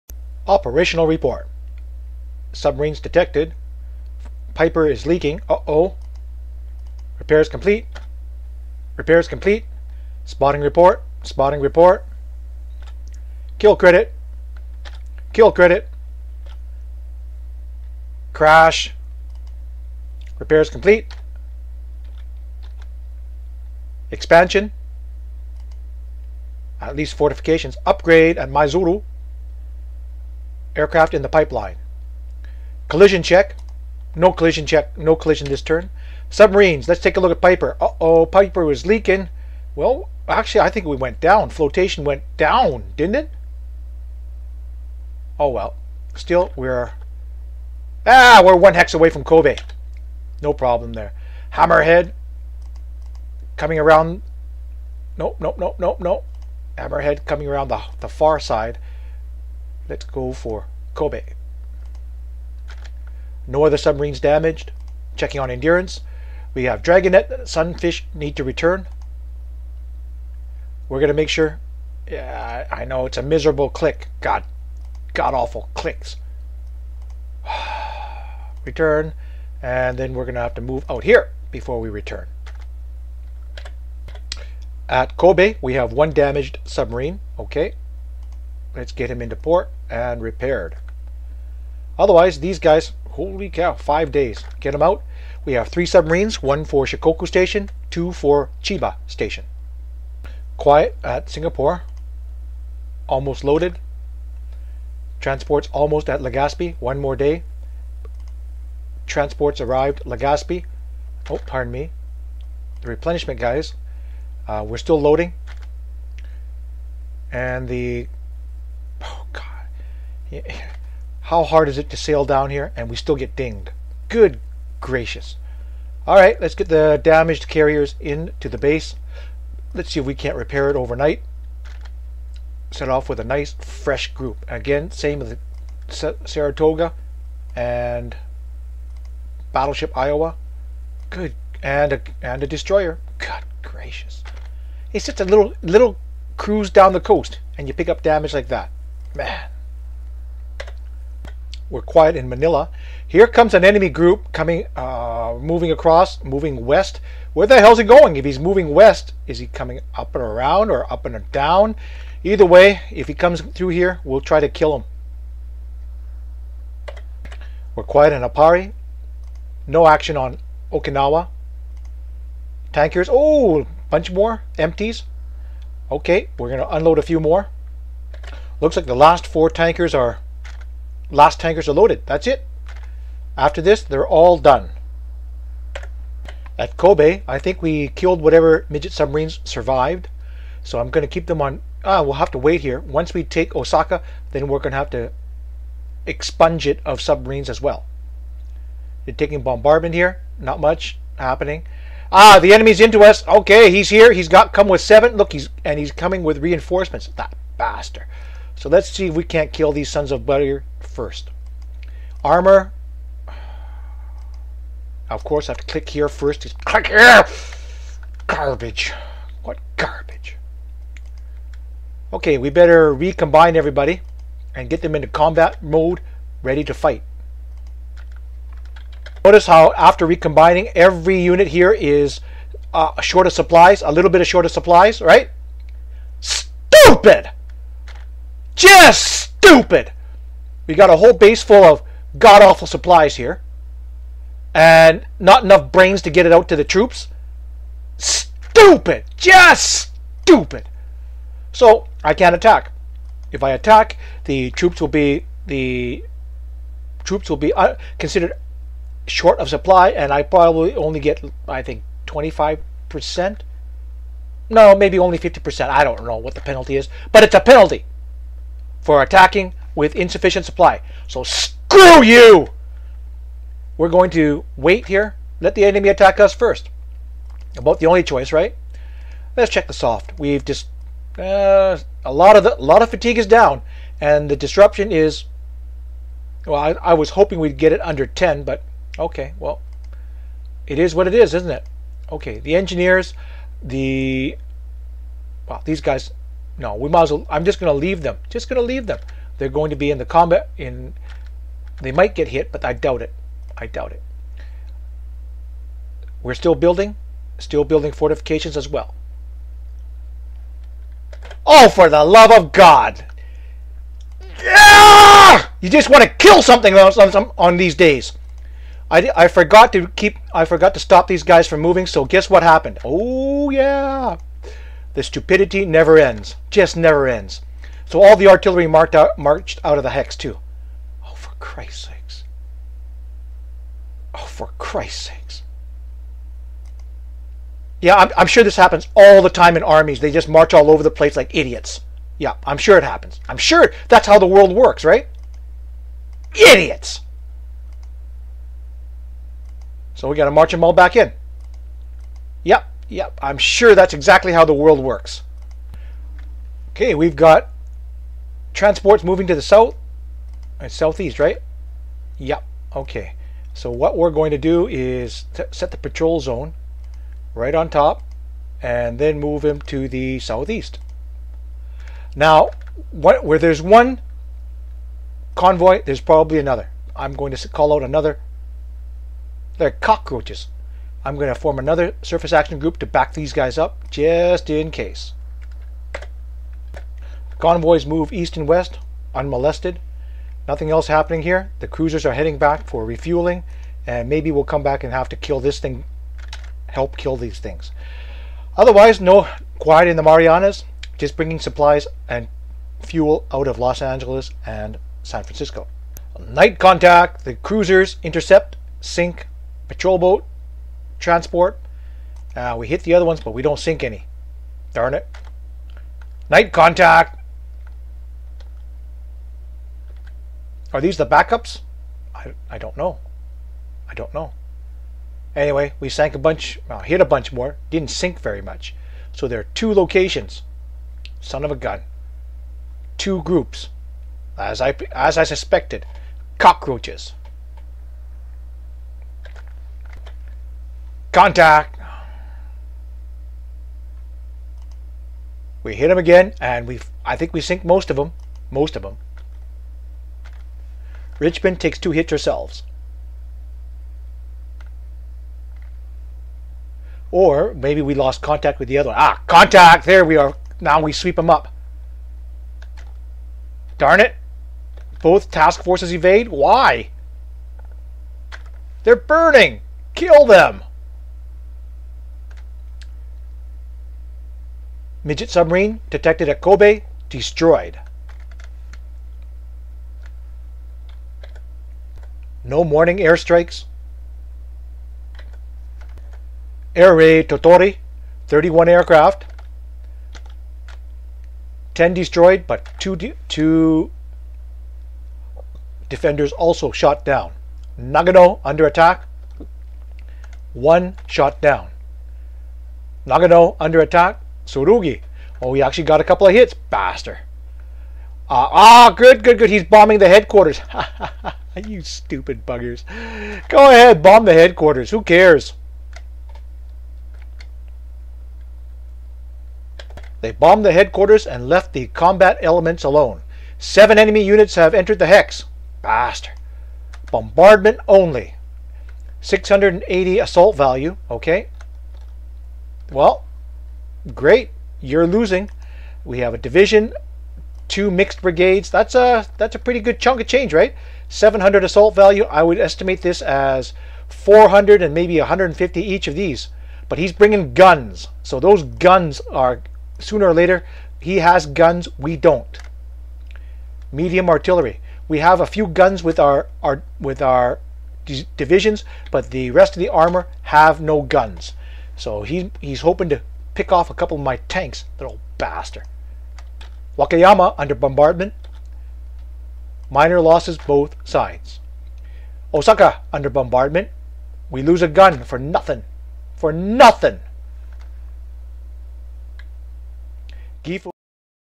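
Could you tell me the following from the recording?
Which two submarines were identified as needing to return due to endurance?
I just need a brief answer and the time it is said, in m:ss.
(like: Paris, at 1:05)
Dragonet, Sunfish, at 1:06.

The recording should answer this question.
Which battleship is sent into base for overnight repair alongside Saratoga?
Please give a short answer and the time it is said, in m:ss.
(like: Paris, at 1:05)
Iowa, at 2:19.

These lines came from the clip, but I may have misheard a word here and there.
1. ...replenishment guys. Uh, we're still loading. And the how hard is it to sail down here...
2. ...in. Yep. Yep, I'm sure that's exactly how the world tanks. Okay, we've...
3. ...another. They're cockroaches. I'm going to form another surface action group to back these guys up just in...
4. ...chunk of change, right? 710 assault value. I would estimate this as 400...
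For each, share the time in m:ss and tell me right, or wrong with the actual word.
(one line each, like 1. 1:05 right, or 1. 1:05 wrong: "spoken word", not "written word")
1. 1:52 right
2. 5:50 wrong: "works", not "tanks"
3. 6:17 right
4. 8:59 wrong: "700", not "710".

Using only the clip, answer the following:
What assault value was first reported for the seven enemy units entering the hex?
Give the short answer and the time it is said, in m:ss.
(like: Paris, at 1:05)
680, at 8:49.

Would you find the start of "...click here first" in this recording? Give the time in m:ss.
3:35.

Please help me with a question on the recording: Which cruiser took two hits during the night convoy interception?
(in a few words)
Richmond.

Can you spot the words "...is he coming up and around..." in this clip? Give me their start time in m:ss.
2:39.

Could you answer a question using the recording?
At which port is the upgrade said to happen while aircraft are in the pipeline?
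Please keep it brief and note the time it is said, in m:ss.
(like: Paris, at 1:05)
Maizuru, at 0:28.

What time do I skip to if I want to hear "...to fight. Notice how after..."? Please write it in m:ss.
3:46.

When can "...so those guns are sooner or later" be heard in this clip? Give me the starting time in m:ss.
9:08.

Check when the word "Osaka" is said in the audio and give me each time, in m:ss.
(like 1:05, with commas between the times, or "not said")
3:13, 9:32.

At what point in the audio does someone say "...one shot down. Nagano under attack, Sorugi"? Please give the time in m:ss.
8:20.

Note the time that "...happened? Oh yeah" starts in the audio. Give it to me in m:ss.
5:22.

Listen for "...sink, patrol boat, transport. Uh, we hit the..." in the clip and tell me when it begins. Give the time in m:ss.
6:48.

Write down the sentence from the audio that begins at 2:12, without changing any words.
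Set off with a nice, fresh group.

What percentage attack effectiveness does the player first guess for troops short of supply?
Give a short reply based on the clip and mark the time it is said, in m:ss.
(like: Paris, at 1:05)
25%, at 4:22.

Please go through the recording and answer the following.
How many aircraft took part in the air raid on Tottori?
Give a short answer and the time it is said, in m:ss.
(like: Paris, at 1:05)
31, at 8:08.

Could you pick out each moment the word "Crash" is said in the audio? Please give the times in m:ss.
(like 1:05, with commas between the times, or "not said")
0:18.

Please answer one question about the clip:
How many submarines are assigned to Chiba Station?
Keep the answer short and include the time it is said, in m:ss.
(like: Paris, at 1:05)
2, at 1:37.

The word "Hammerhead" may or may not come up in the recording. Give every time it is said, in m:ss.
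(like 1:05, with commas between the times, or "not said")
0:51, 0:56.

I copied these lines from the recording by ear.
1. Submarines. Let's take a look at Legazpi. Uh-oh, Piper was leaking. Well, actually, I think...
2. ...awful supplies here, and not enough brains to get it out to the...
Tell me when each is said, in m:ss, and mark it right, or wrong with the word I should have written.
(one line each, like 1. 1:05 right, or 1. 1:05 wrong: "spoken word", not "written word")
1. 0:36 wrong: "Piper", not "Legazpi"
2. 4:02 right.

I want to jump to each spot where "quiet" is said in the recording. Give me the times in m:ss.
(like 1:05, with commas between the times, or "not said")
1:40, 2:31, 2:47, 6:39.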